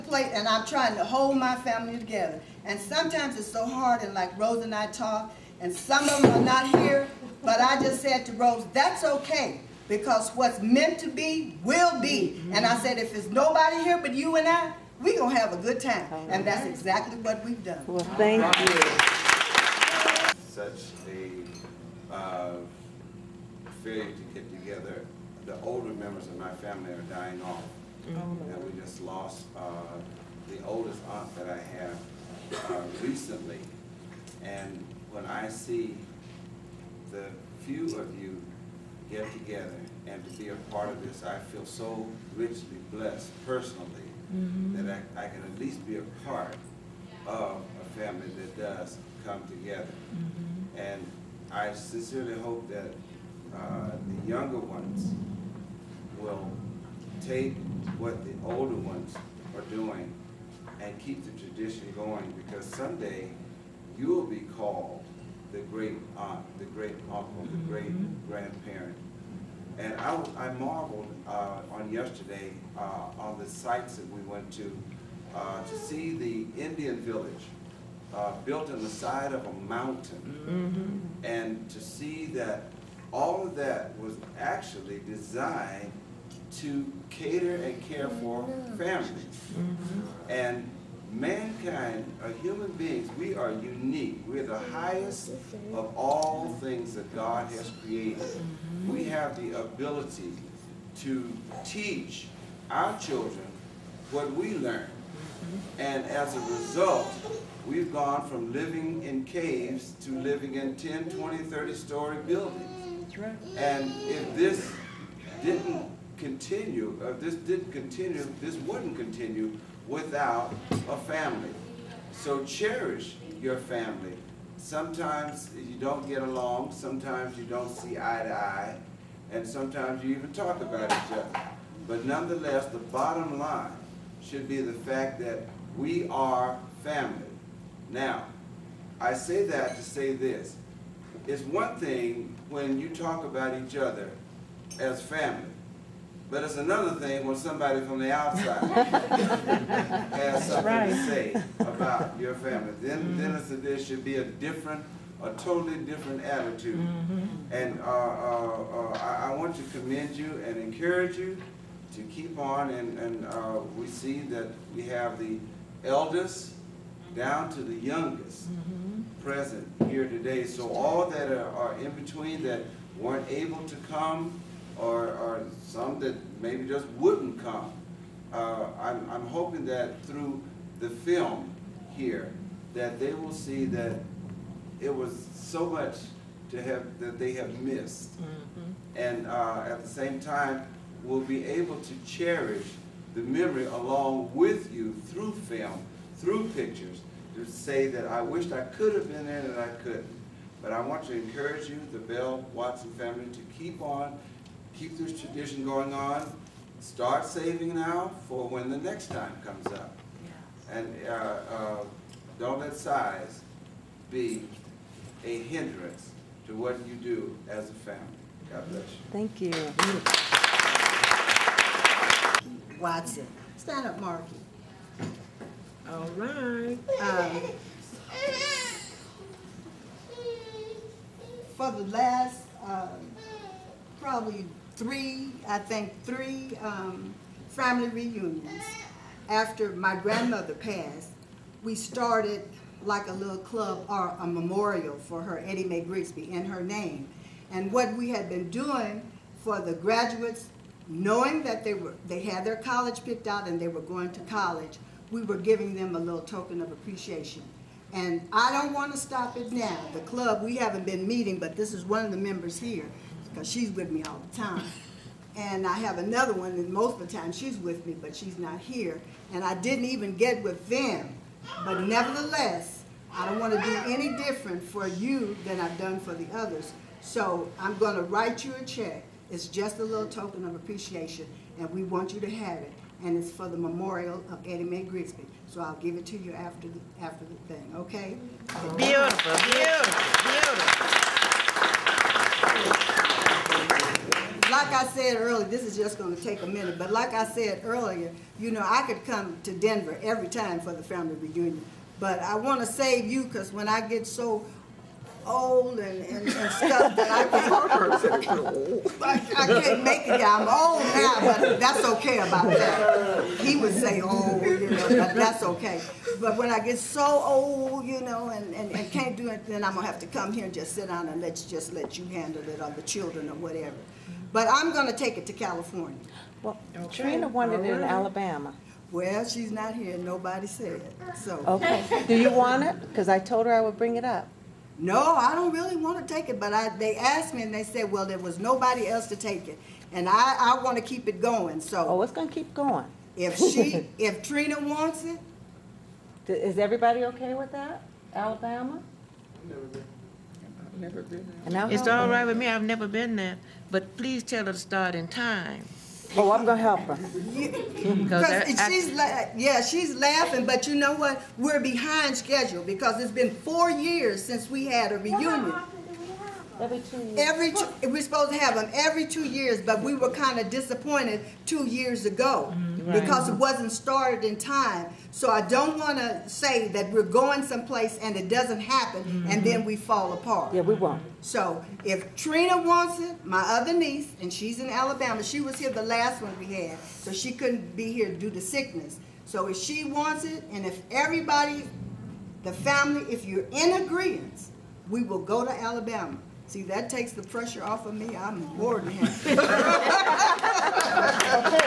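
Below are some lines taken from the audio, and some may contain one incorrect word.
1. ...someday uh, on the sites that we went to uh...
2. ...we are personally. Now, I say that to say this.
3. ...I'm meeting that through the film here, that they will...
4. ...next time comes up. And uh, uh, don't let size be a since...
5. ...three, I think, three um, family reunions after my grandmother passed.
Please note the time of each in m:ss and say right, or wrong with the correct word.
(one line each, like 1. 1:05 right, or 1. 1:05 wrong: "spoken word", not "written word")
1. 1:11 wrong: "yesterday", not "someday"
2. 2:15 wrong: "family", not "personally"
3. 2:59 wrong: "hoping", not "meeting"
4. 3:28 wrong: "hindrance", not "since"
5. 3:54 right.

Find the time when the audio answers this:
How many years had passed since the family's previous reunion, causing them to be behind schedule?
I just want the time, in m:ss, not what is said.
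6:03.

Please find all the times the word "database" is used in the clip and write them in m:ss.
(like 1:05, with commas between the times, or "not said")
not said.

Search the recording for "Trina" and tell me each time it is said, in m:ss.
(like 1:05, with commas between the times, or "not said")
5:27, 5:44, 6:22.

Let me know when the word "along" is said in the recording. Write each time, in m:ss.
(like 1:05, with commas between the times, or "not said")
2:06, 3:13.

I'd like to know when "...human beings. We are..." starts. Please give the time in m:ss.
1:32.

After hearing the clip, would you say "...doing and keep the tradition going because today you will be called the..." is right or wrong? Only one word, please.
wrong.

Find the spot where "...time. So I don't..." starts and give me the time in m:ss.
6:14.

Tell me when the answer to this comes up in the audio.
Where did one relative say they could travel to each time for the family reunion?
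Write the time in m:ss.
4:59.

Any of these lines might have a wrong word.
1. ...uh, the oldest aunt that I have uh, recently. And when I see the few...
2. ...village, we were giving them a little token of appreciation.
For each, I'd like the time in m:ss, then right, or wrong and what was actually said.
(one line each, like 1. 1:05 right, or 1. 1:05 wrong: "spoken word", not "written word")
1. 0:29 right
2. 4:14 wrong: "college", not "village".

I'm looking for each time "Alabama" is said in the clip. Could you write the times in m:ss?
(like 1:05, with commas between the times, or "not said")
5:27, 5:48, 6:24, 6:35.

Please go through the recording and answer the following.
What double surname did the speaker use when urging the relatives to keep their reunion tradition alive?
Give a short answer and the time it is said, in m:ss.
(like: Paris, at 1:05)
Bell Watson, at 3:22.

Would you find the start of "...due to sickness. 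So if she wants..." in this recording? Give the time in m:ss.
6:28.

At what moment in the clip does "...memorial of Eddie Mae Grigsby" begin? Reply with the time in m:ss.
4:43.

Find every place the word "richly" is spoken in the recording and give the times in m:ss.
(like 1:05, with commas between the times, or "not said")
0:42.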